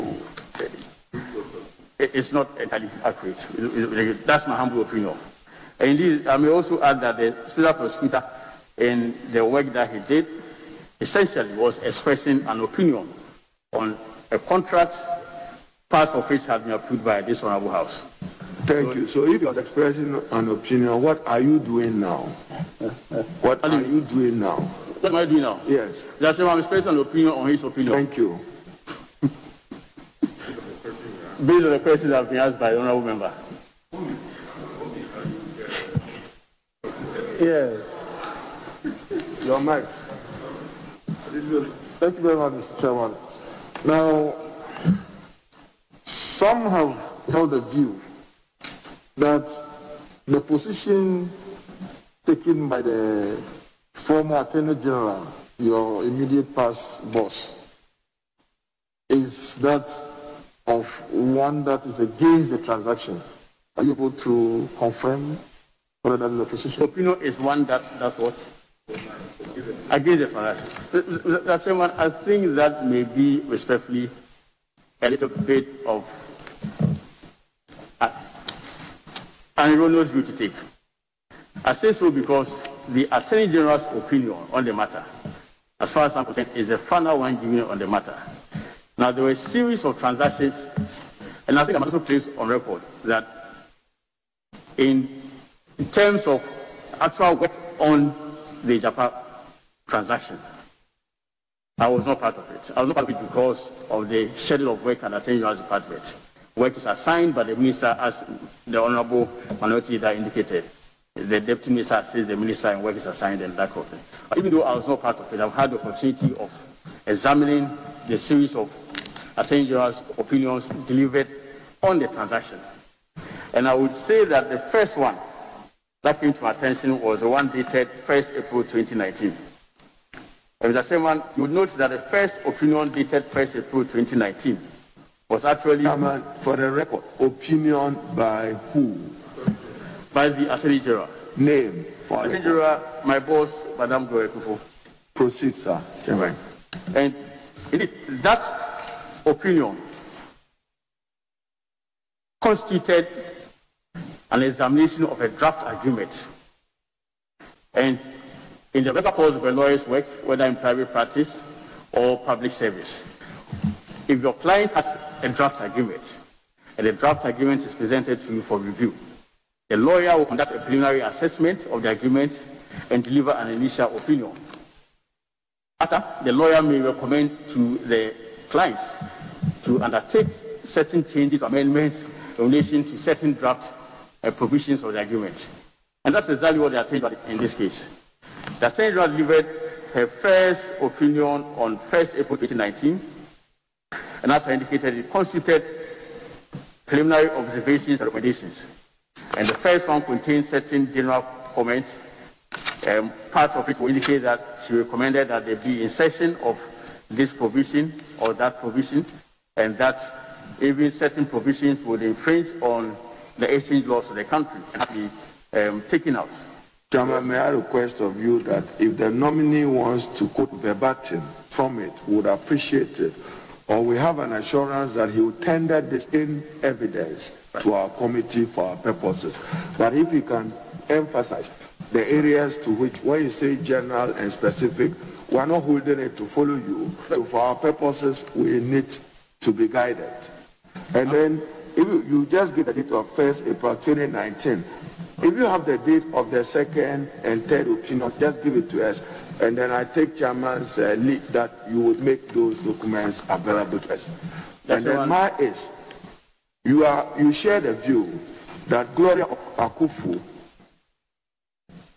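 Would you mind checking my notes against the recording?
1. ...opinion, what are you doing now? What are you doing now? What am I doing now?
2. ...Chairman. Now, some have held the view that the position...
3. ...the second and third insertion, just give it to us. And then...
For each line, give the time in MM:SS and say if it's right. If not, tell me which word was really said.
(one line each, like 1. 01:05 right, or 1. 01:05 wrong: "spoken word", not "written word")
1. 00:20 right
2. 00:42 right
3. 04:06 wrong: "opinion", not "insertion".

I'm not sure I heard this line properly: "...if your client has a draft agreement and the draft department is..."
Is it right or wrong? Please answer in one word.
wrong.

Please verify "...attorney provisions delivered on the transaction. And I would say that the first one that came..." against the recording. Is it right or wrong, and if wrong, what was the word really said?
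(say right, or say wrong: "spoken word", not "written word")
wrong: "opinions", not "provisions".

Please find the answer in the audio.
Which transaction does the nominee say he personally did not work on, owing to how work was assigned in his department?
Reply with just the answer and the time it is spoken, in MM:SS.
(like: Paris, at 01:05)
Agyapa, at 01:38.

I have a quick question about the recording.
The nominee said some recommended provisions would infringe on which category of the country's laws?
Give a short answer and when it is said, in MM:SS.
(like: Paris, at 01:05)
exchange laws, at 03:33.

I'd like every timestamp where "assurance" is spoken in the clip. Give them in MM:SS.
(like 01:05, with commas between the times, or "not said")
03:44.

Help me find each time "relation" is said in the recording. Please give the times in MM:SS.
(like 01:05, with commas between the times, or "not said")
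03:02.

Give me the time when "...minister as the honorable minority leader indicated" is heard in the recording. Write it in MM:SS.
01:47.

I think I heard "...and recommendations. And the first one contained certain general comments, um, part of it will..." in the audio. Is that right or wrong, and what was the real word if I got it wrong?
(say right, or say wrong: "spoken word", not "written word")
right.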